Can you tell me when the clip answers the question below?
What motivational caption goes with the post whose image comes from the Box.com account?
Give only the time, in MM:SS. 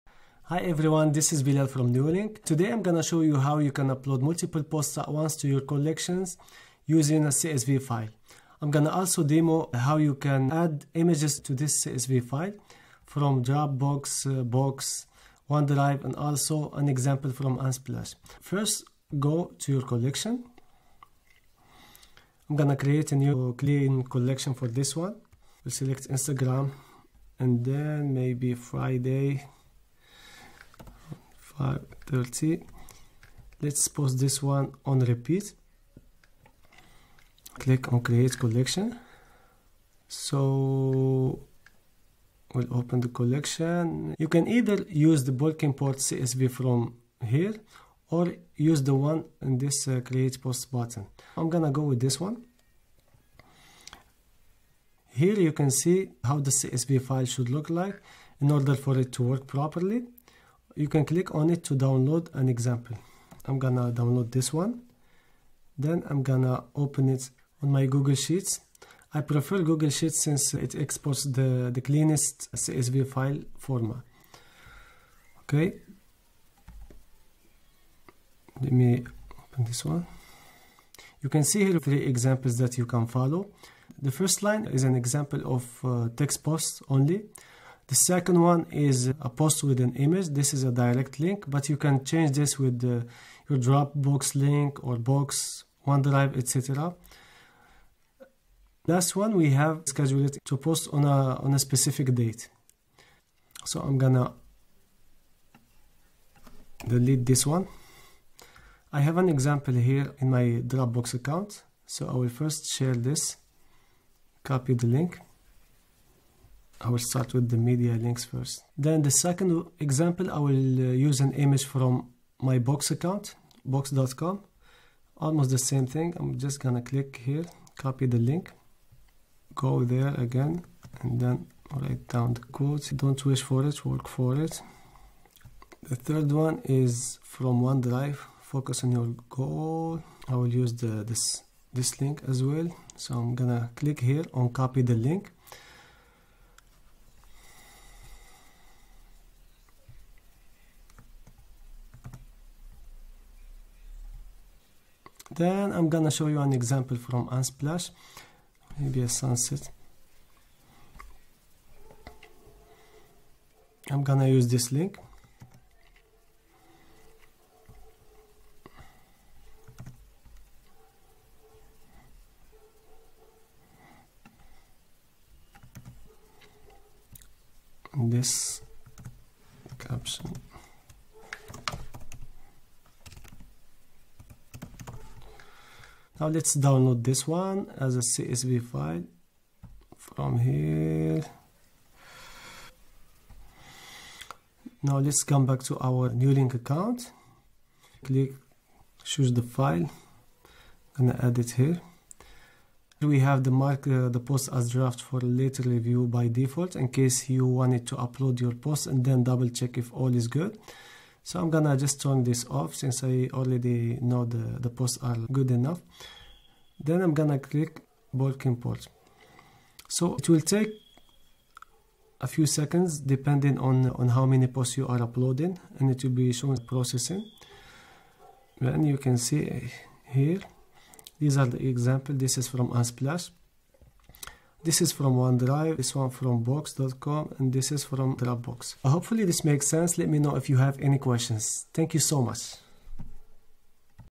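02:12.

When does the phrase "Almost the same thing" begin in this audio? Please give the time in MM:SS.
02:05.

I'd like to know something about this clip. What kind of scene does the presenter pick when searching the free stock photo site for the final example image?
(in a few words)
A sunset.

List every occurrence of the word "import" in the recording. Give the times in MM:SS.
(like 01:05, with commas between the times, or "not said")
00:45, 03:38.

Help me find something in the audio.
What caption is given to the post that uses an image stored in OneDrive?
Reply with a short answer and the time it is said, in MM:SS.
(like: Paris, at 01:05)
Focus on your goal, at 02:18.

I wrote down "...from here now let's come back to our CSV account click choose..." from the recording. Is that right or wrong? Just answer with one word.
wrong.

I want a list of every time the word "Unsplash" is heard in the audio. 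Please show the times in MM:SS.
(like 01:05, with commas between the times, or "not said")
00:17, 02:37, 03:52.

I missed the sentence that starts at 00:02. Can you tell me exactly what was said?
Today I'm gonna show you how you can upload multiple posts at once to your collections using a CSV file.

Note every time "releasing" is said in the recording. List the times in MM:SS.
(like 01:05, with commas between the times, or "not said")
not said.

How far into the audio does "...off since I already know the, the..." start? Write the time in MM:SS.
03:32.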